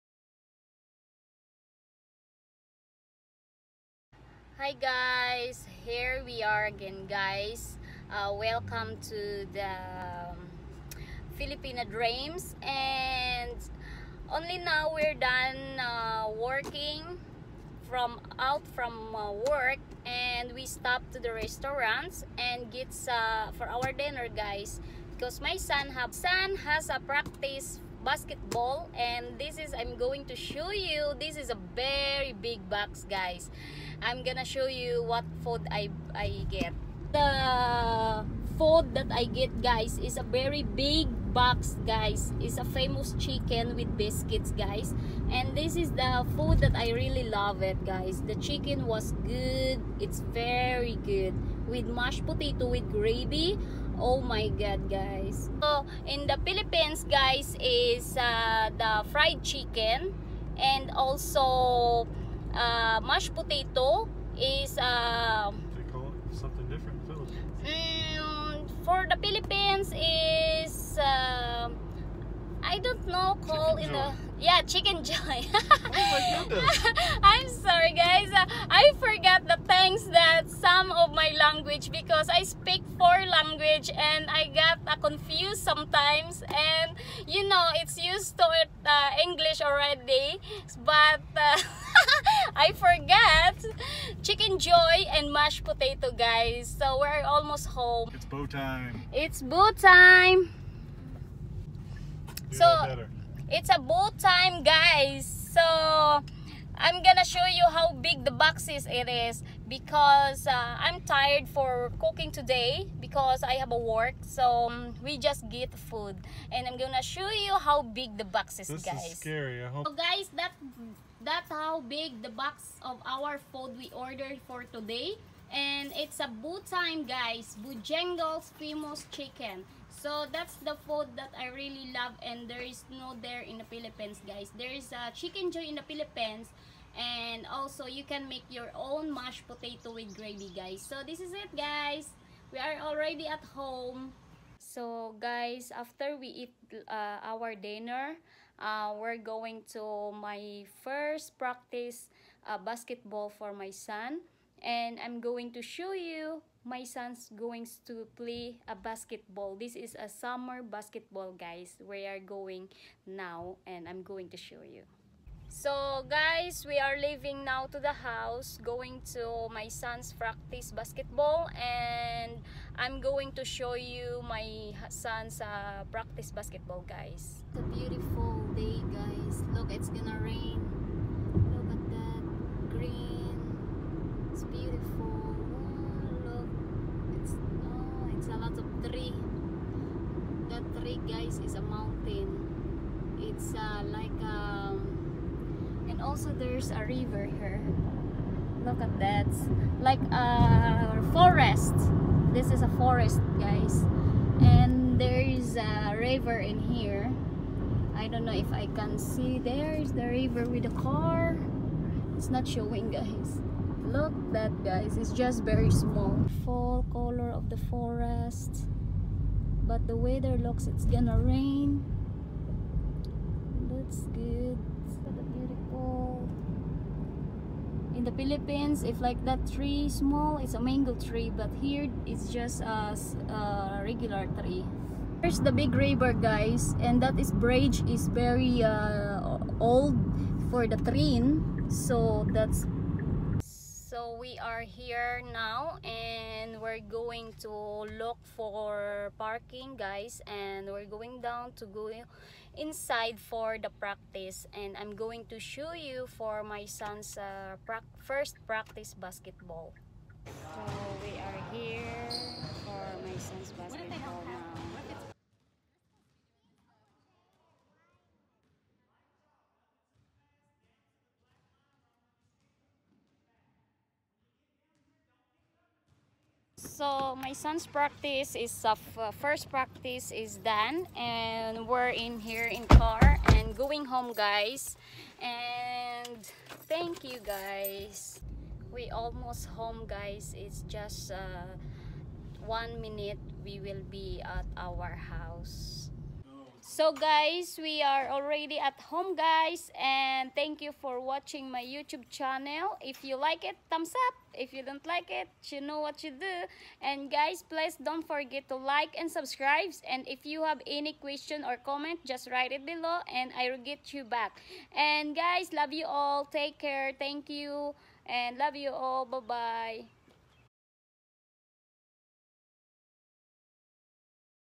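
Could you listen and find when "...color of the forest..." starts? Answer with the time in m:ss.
3:36.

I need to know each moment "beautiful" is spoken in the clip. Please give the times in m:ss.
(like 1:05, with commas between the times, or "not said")
2:57, 3:45.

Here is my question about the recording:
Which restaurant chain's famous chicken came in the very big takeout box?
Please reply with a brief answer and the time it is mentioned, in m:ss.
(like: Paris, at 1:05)
Bojangles, at 2:07.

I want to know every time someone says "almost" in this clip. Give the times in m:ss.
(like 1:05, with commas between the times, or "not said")
1:37, 4:48.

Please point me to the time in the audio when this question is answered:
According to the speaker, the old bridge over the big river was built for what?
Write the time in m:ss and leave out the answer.
4:00.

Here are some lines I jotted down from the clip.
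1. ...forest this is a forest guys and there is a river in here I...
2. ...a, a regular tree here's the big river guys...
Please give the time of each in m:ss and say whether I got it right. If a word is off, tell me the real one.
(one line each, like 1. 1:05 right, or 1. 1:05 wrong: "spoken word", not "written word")
1. 3:21 right
2. 3:52 right.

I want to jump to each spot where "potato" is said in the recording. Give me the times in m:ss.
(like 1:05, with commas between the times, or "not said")
0:52, 1:03, 1:35, 2:19.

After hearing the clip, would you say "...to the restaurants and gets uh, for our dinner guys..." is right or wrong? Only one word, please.
right.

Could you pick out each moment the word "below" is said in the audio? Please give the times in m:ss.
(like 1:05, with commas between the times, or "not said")
5:12.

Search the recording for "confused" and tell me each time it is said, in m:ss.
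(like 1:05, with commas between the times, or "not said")
1:25.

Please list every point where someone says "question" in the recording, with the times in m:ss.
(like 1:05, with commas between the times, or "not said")
5:10.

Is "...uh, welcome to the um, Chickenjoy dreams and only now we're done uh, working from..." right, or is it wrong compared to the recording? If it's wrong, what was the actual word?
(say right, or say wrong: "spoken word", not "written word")
wrong: "Filipina", not "Chickenjoy".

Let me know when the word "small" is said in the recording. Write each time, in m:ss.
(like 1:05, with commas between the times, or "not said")
3:35, 3:49.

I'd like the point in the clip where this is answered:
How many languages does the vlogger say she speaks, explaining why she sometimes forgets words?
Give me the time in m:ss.
1:22.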